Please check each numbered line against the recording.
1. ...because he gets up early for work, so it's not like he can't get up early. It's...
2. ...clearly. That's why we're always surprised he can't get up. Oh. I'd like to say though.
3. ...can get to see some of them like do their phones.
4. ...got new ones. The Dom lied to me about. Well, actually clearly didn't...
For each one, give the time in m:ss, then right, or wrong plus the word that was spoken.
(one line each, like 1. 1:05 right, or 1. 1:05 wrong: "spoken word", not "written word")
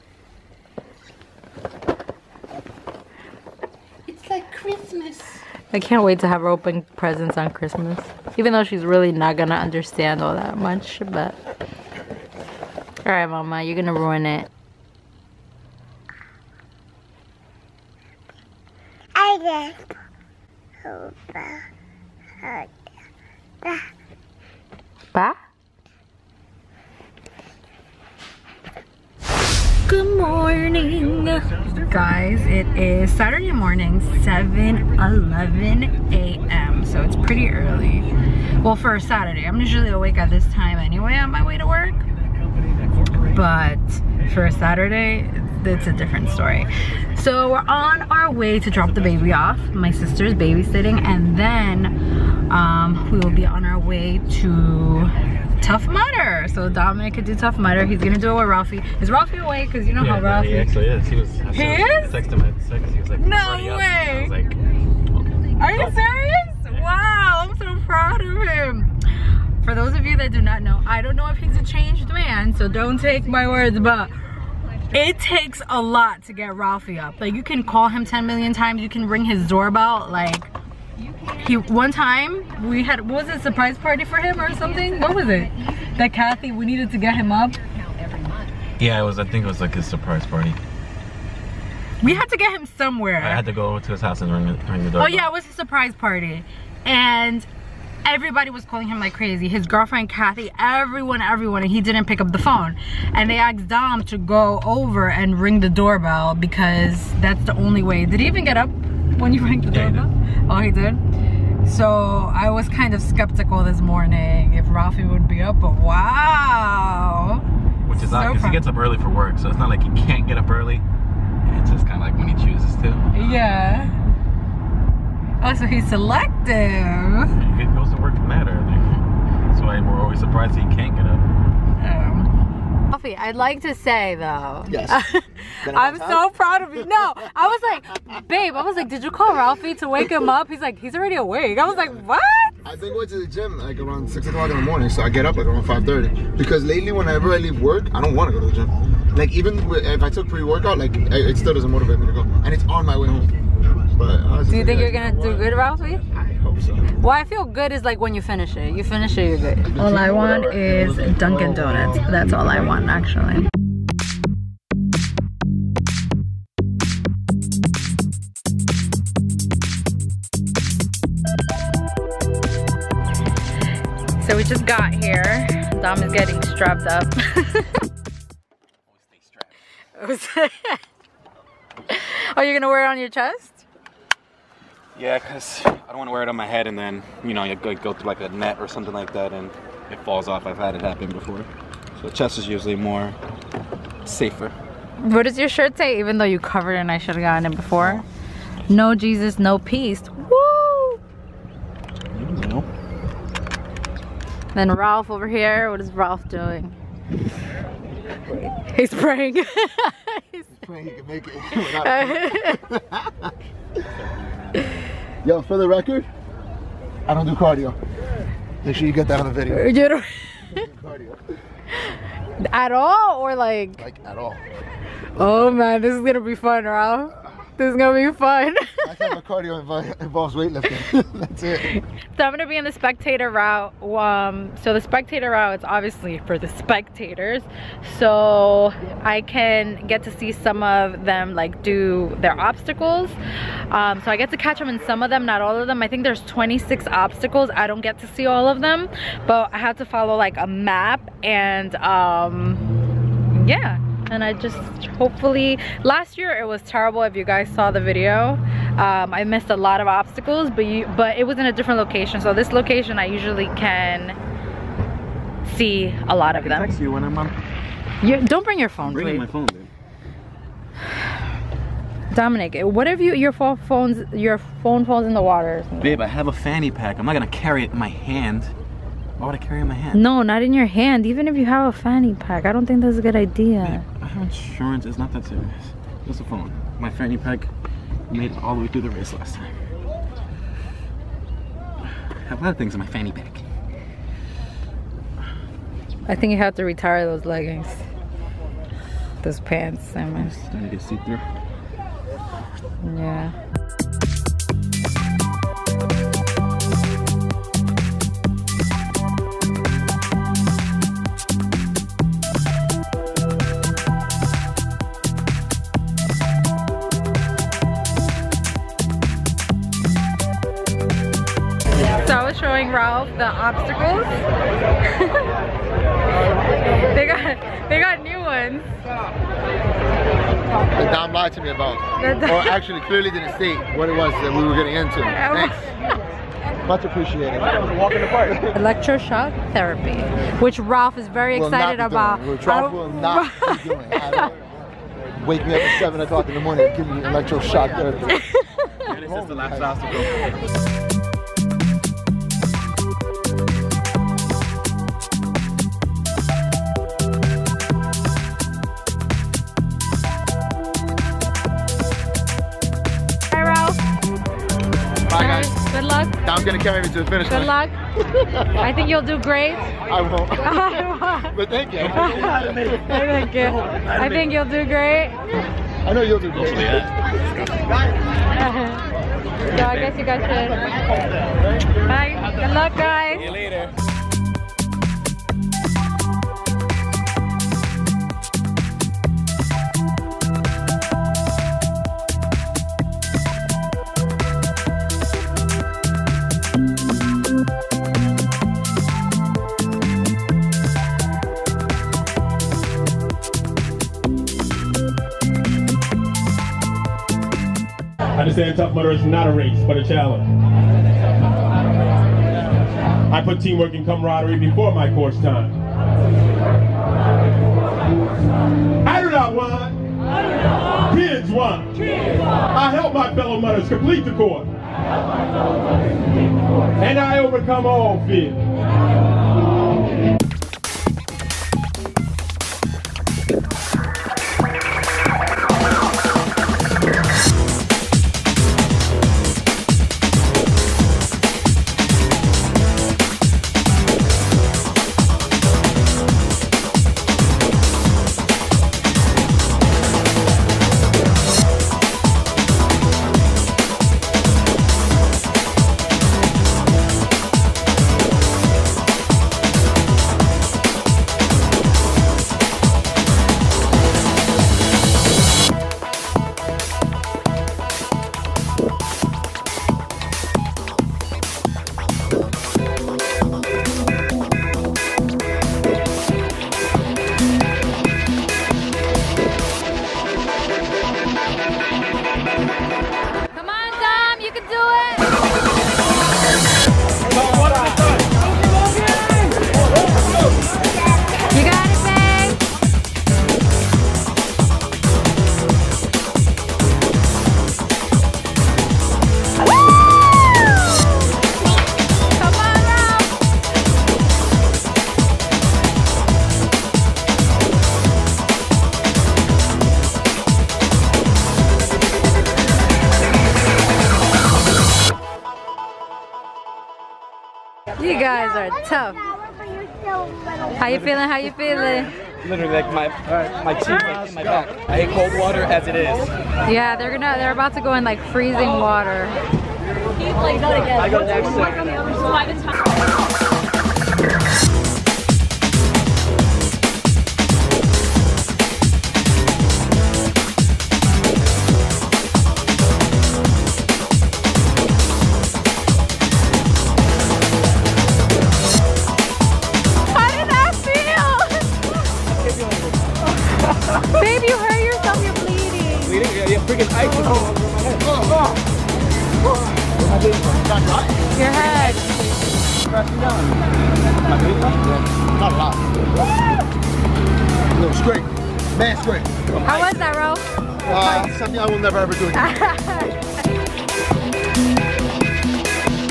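1. 1:58 right
2. 2:08 wrong: "early", not "clearly"
3. 3:59 wrong: "obstacles", not "phones"
4. 5:27 right.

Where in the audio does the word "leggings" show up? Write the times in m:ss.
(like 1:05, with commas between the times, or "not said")
4:57.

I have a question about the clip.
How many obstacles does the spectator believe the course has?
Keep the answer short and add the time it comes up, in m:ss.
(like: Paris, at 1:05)
26, at 4:06.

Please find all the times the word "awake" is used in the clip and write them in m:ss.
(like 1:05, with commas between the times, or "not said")
0:39, 2:21.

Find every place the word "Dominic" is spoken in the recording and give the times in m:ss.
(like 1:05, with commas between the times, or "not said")
0:56, 4:32.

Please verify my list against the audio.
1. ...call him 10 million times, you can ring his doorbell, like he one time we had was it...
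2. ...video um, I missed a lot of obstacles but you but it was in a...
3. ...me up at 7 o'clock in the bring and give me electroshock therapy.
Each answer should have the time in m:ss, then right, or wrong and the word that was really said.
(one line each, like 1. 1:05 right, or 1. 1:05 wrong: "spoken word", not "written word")
1. 1:17 right
2. 4:17 right
3. 5:45 wrong: "morning", not "bring".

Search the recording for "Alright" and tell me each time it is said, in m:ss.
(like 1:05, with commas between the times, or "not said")
0:13.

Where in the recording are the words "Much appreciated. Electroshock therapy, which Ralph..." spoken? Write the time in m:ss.
5:36.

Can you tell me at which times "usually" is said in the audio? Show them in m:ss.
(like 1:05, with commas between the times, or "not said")
0:39, 3:12, 4:23.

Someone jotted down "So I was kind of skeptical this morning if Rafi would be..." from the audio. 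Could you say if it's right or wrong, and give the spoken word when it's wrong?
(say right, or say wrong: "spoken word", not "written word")
right.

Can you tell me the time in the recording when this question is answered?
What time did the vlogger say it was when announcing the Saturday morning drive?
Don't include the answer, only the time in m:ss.
0:34.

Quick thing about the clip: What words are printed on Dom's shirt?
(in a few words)
No Jesus, no peace.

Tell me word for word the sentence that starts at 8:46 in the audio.
Yeah, they're gonna they're about to go in like freezing water.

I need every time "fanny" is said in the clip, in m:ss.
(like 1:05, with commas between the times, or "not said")
4:36, 4:41, 4:46, 4:52.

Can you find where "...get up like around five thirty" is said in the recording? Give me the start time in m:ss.
2:25.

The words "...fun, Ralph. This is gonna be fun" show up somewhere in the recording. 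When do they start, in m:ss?
3:46.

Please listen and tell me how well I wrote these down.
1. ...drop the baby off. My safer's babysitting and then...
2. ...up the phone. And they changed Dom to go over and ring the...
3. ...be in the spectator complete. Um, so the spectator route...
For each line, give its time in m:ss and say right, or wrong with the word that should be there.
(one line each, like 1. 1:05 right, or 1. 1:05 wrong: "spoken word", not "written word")
1. 0:48 wrong: "sister", not "safer"
2. 1:42 wrong: "asked", not "changed"
3. 3:52 wrong: "route", not "complete".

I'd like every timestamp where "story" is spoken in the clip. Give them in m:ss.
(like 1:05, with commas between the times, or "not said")
0:46.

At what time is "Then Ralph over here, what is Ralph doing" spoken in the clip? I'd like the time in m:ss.
3:24.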